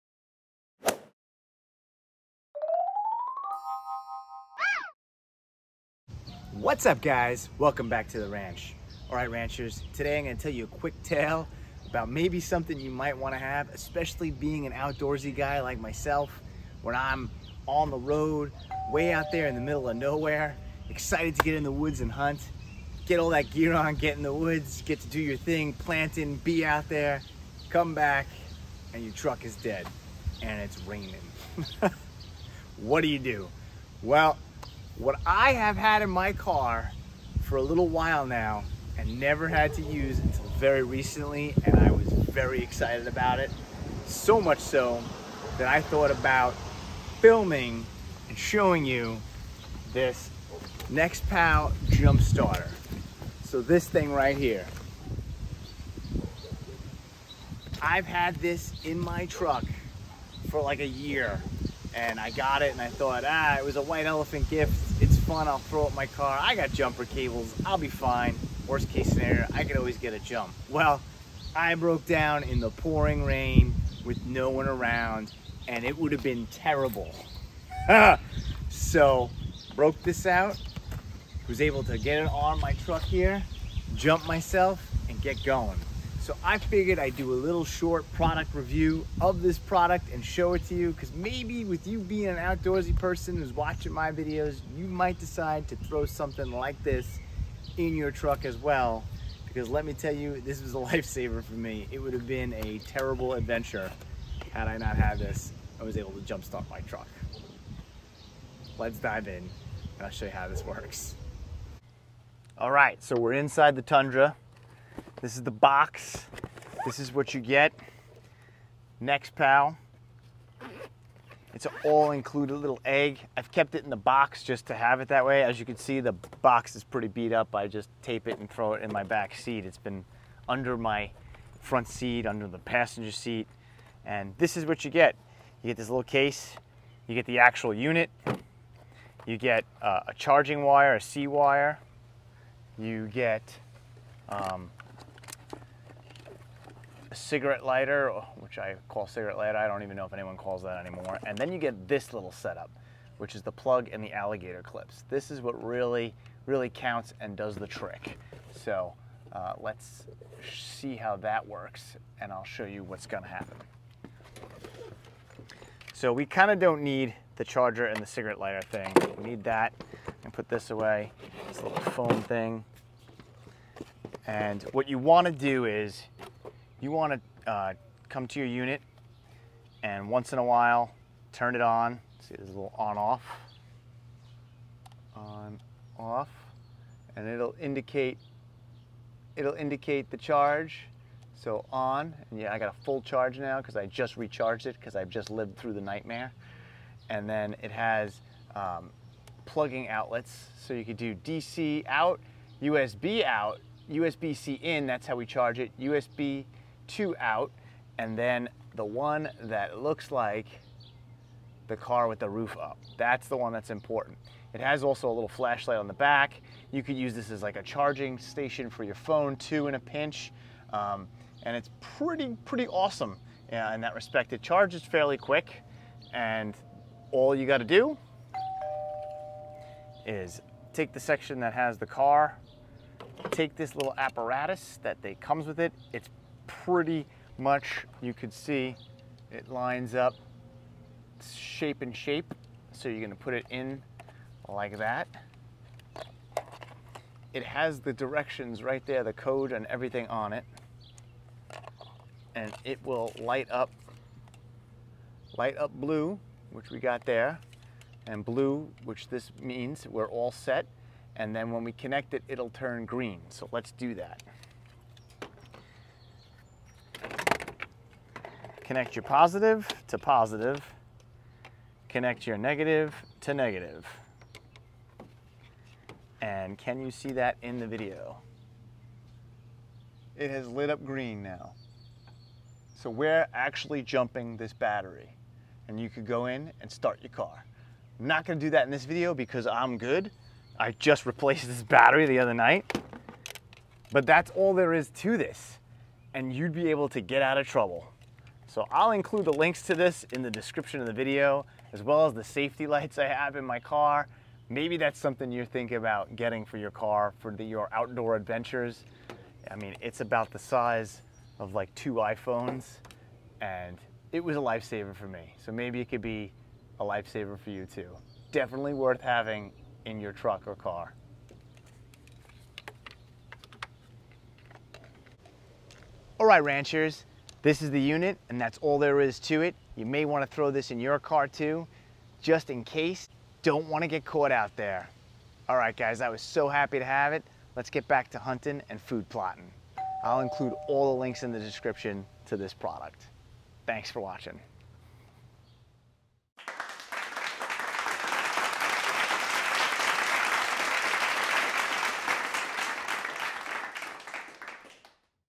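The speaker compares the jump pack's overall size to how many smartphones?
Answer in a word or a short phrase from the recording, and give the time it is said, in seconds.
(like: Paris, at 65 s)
2 iPhones, at 311 s.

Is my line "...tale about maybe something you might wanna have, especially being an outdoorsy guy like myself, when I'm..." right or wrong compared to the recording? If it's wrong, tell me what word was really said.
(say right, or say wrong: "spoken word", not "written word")
right.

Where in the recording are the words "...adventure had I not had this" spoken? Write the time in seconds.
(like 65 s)
103 s.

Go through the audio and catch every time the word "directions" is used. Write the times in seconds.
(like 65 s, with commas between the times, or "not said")
247 s.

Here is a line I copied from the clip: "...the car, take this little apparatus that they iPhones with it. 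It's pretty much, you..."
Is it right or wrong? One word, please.
wrong.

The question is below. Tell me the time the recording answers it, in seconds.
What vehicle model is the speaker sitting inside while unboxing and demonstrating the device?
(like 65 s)
113 s.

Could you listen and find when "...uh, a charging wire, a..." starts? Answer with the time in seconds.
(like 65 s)
139 s.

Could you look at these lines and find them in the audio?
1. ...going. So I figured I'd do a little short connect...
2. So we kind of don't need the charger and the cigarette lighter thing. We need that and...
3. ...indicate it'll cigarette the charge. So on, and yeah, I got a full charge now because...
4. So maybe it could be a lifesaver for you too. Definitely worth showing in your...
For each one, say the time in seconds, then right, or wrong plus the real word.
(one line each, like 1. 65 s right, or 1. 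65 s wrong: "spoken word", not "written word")
1. 85 s wrong: "product", not "connect"
2. 165 s right
3. 187 s wrong: "indicate", not "cigarette"
4. 315 s wrong: "having", not "showing".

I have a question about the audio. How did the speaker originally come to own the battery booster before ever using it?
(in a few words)
White elephant gift.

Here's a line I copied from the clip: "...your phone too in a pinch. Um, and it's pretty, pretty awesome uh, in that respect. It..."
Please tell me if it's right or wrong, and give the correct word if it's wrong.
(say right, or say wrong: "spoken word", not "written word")
right.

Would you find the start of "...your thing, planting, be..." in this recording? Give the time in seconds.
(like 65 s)
25 s.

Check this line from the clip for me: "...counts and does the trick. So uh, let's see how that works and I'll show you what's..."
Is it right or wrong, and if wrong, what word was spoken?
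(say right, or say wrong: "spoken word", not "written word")
right.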